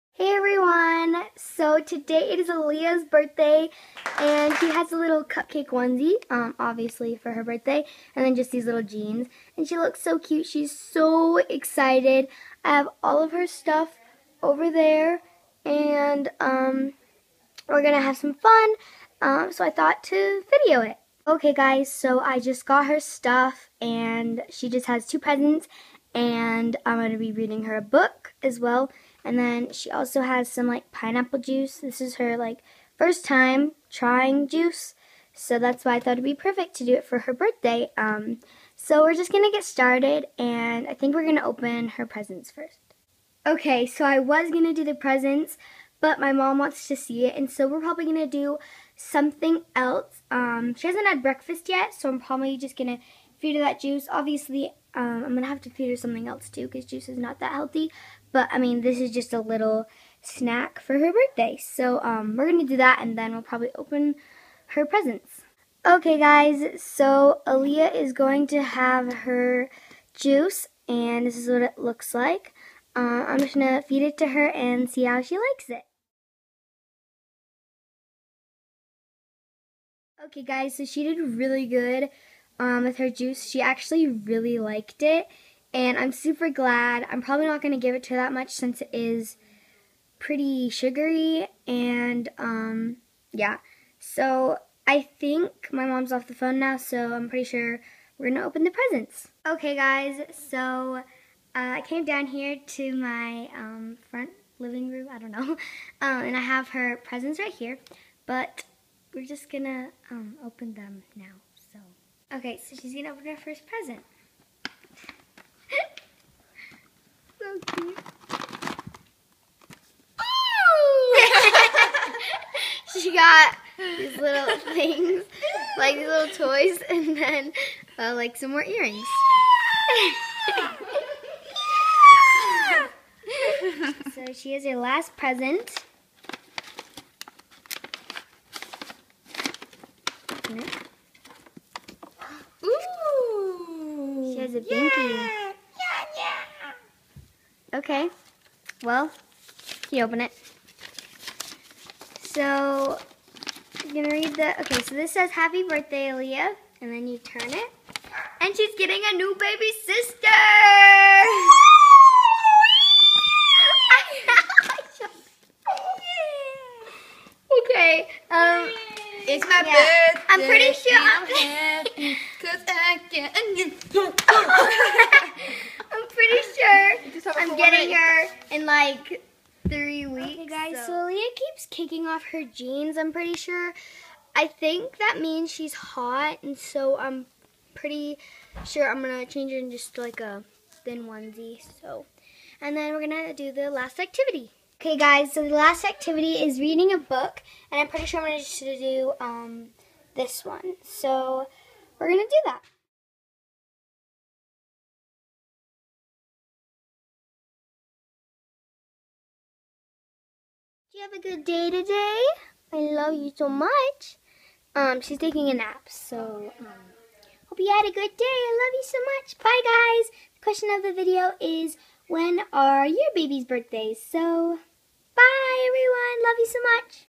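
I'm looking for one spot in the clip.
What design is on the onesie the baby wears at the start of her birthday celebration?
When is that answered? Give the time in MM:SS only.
00:05.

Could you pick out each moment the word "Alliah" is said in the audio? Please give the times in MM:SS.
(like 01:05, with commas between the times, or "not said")
00:02, 01:07, 02:36.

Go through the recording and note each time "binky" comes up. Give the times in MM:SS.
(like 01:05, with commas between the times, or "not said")
02:24.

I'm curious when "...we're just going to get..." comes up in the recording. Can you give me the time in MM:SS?
00:39.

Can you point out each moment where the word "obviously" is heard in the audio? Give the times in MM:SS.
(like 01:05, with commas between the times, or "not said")
00:06, 00:54.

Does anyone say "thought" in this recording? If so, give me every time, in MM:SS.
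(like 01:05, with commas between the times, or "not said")
00:19, 00:35.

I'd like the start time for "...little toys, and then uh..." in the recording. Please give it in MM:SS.
02:06.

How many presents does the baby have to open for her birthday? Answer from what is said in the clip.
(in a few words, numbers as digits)
2.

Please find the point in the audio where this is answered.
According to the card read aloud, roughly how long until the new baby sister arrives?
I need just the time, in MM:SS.
02:59.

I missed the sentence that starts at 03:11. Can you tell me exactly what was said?
So, And then we're going to do the last activity.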